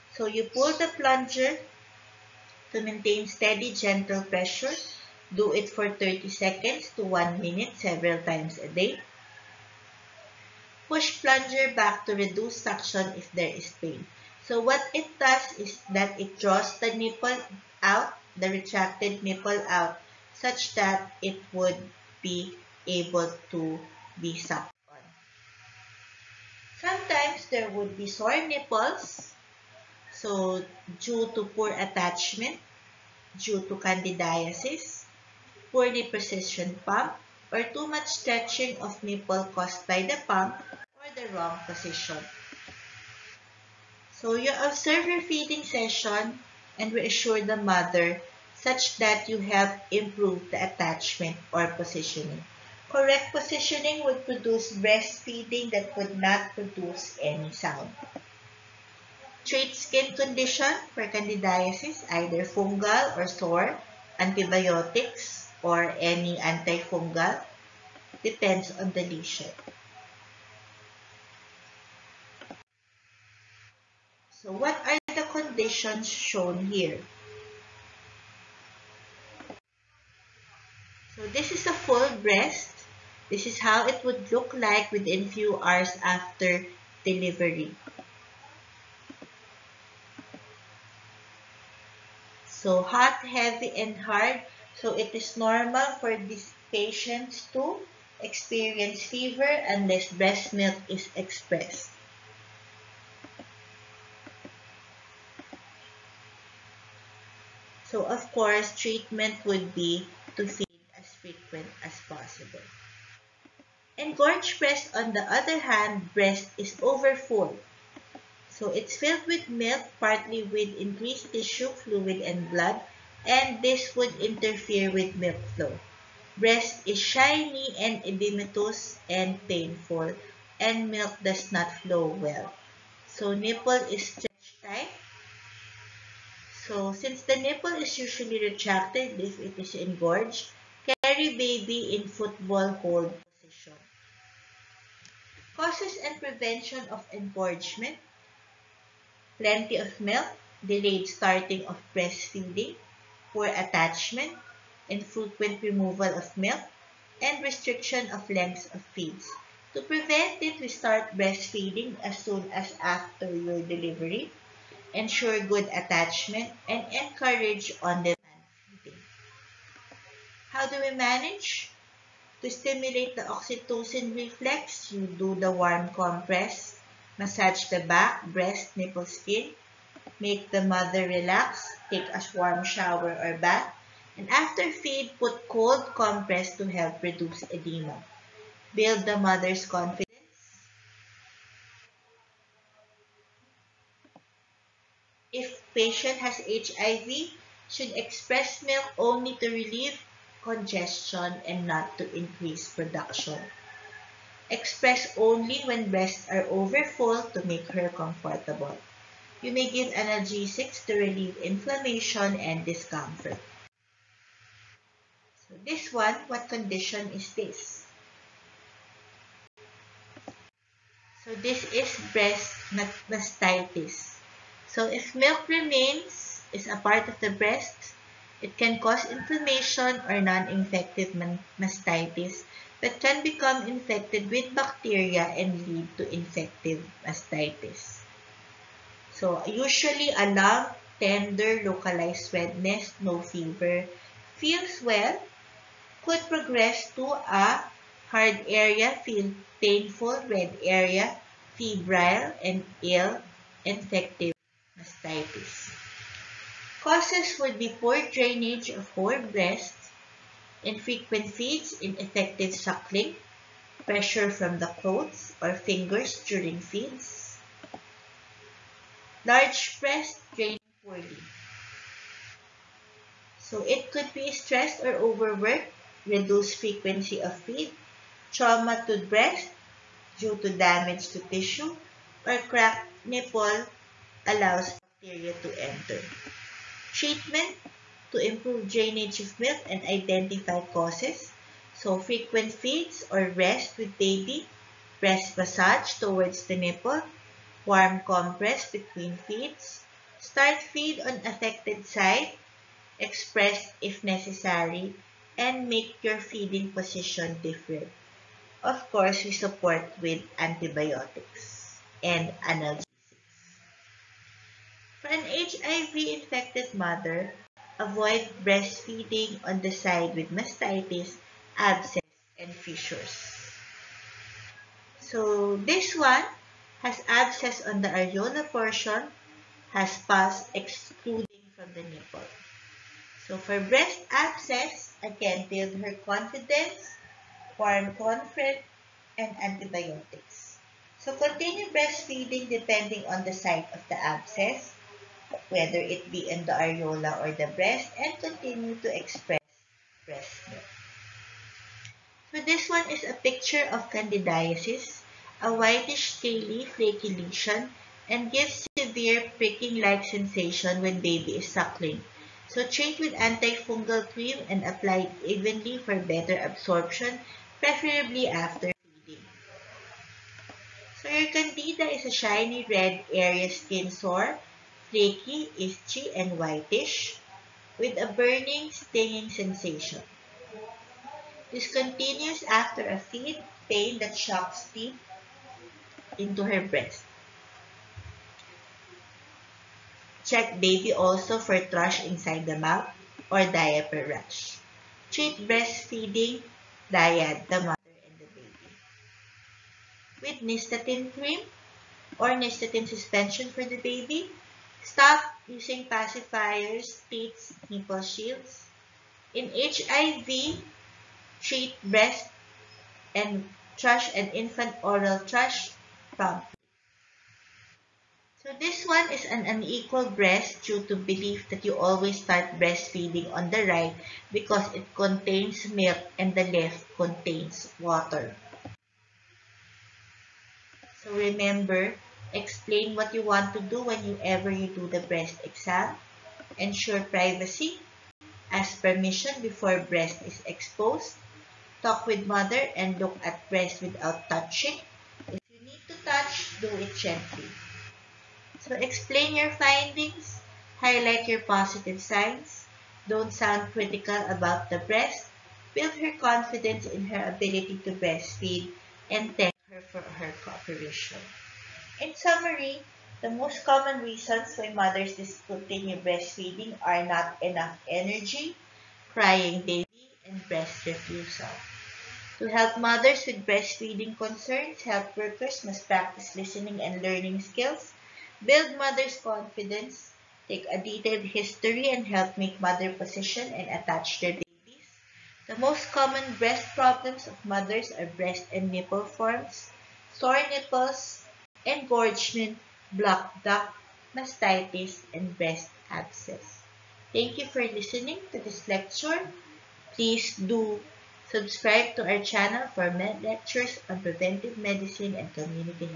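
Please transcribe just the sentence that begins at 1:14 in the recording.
So what are the conditions shown here?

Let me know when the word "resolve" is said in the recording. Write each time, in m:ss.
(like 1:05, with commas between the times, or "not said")
not said.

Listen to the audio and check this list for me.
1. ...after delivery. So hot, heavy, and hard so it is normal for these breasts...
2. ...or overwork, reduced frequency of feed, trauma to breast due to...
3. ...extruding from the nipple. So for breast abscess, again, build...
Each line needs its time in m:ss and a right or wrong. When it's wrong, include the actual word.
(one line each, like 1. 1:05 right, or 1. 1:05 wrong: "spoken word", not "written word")
1. 1:26 wrong: "patients", not "breasts"
2. 4:34 right
3. 5:30 right.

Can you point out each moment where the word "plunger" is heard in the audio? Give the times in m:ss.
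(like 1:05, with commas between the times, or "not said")
0:00, 0:11.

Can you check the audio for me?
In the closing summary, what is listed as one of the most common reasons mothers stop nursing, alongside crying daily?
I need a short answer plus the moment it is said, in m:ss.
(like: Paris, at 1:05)
breast refusal, at 7:50.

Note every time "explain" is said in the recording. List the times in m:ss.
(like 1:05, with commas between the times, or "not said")
7:12, 7:28.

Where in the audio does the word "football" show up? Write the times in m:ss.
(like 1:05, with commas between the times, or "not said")
2:22.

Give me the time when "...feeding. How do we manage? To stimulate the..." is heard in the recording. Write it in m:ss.
2:48.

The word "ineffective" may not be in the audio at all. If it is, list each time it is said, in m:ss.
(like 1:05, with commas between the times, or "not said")
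4:21.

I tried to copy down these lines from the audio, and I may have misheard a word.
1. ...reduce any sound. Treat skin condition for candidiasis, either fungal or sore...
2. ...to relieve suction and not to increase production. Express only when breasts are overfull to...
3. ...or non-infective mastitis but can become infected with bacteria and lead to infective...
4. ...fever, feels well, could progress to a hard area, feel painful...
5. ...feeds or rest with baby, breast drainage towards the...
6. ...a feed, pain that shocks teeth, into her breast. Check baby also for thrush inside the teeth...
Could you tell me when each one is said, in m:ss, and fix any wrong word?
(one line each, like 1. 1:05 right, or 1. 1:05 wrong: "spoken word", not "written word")
1. 0:56 wrong: "produce", not "reduce"
2. 3:19 wrong: "congestion", not "suction"
3. 3:50 right
4. 4:03 right
5. 4:52 wrong: "massage", not "drainage"
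6. 6:22 wrong: "mouth", not "teeth".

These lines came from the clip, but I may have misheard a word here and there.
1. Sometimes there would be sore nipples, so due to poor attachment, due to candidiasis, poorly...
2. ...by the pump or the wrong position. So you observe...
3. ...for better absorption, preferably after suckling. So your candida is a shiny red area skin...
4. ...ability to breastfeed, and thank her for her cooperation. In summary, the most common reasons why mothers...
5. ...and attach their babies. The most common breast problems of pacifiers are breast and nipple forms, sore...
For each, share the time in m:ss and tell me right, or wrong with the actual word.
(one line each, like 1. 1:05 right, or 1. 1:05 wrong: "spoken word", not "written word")
1. 0:26 right
2. 0:39 right
3. 6:05 wrong: "feeding", not "suckling"
4. 7:37 right
5. 8:03 wrong: "mothers", not "pacifiers".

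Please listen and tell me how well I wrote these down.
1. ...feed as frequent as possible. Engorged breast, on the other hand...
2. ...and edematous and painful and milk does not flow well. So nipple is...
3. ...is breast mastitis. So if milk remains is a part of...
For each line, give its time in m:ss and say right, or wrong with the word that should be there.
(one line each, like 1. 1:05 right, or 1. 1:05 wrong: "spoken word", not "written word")
1. 1:50 right
2. 2:07 right
3. 3:41 right.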